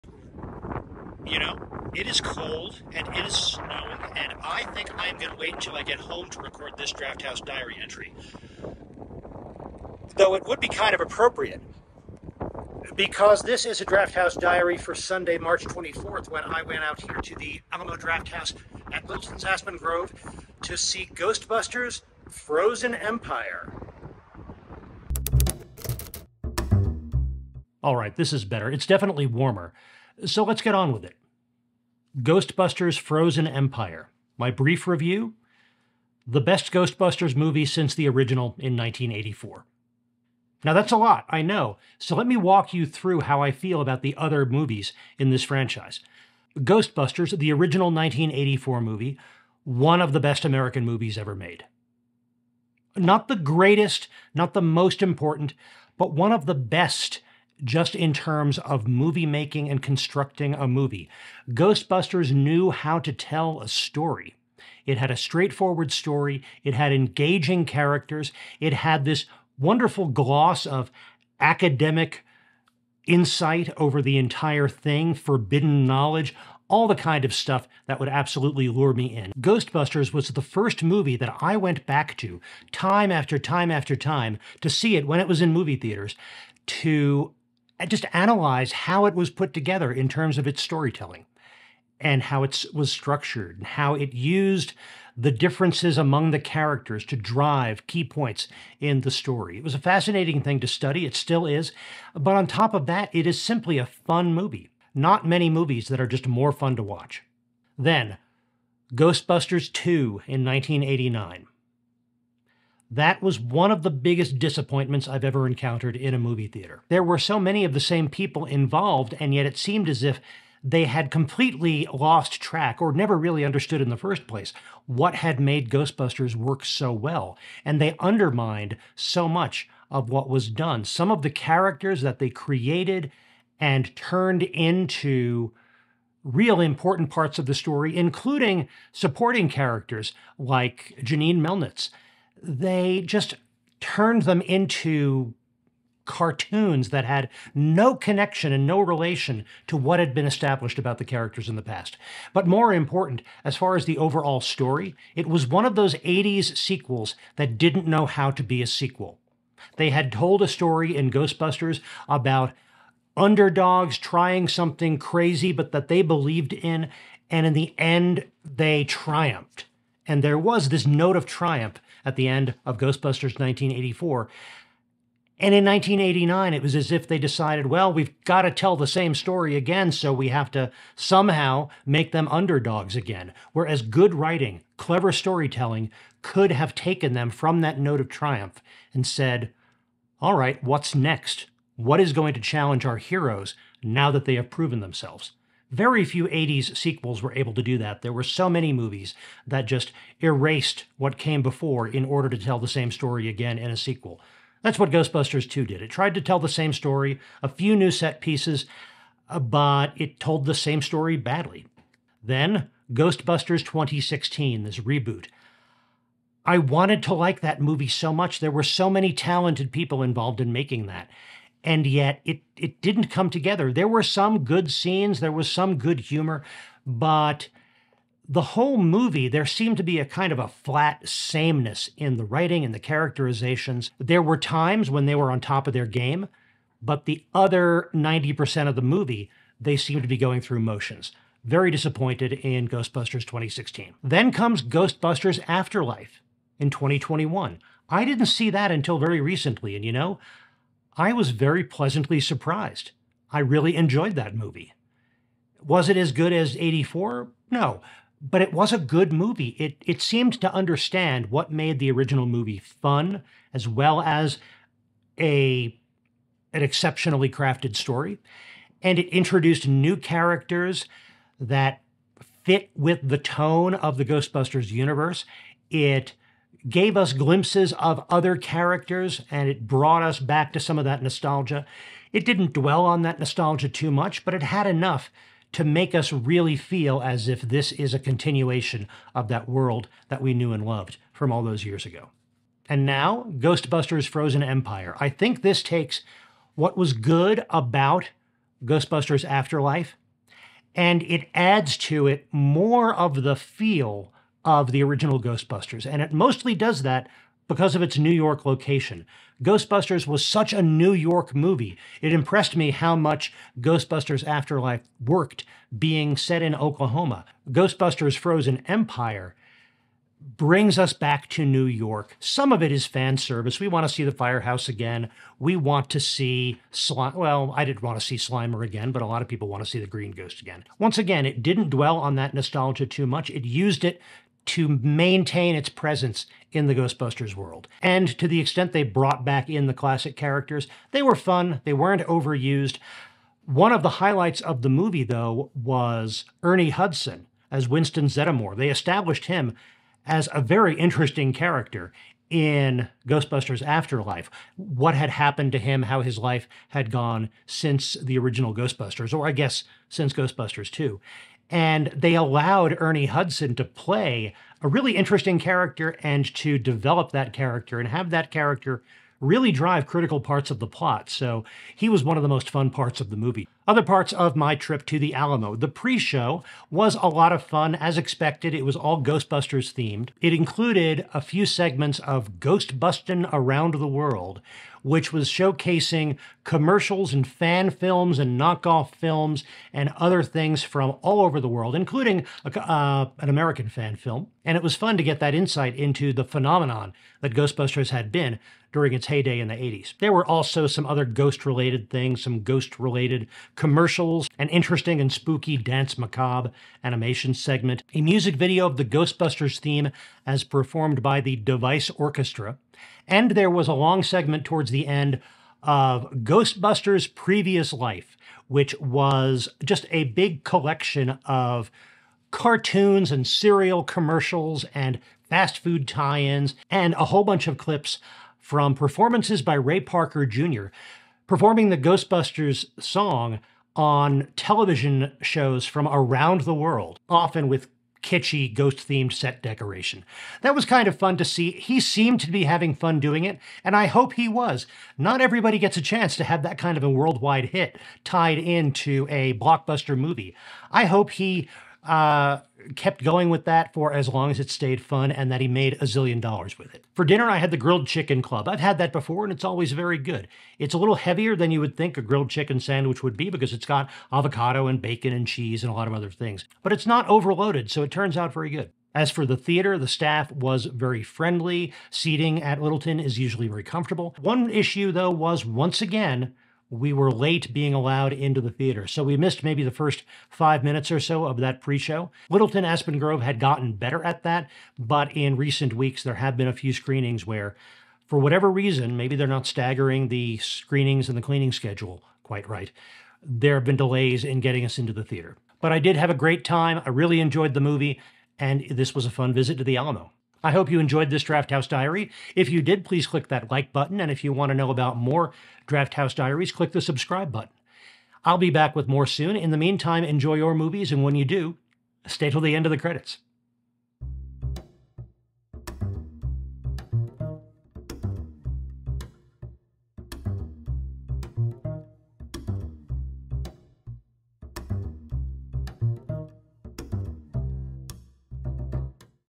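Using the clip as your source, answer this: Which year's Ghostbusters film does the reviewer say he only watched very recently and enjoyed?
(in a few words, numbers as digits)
2021.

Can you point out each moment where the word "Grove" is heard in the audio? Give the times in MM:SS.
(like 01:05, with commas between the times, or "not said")
00:19, 08:02.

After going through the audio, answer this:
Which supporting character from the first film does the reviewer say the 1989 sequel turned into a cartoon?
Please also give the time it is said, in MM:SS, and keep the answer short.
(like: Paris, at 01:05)
Janine Melnitz, at 02:21.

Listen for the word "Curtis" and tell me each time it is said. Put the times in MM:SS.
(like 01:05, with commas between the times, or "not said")
not said.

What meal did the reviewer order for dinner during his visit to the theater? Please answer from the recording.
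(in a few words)
grilled chicken club.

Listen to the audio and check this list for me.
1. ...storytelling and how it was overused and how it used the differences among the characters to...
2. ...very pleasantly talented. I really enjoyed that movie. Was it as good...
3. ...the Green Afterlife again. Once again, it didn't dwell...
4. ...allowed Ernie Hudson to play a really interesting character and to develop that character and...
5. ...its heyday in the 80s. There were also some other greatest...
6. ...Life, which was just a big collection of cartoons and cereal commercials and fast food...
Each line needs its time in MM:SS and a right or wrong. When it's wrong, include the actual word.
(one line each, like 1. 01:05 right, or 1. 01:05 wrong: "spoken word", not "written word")
1. 01:30 wrong: "structured", not "overused"
2. 04:11 wrong: "surprised", not "talented"
3. 05:29 wrong: "Ghost", not "Afterlife"
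4. 06:02 right
5. 06:38 wrong: "ghost", not "greatest"
6. 06:57 right.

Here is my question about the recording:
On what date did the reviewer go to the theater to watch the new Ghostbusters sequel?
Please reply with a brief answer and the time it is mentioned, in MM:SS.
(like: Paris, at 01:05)
Sunday, March 24th, at 00:14.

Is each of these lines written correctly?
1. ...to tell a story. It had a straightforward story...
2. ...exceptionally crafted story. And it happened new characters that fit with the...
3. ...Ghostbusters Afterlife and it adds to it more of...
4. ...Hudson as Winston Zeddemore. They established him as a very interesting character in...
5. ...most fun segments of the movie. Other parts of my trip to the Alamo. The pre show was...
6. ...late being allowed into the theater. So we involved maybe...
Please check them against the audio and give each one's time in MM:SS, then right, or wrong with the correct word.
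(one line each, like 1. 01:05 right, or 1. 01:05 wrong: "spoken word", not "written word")
1. 01:02 right
2. 04:26 wrong: "introduced", not "happened"
3. 04:58 right
4. 05:46 right
5. 06:12 wrong: "parts", not "segments"
6. 07:57 wrong: "missed", not "involved".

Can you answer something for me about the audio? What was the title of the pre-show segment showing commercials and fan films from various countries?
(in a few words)
Ghost Bustin' Around the World.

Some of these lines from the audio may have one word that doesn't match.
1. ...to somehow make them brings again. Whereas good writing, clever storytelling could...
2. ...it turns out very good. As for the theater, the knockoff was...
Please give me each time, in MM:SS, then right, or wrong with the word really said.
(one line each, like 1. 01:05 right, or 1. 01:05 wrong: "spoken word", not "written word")
1. 03:00 wrong: "underdogs", not "brings"
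2. 07:47 wrong: "staff", not "knockoff".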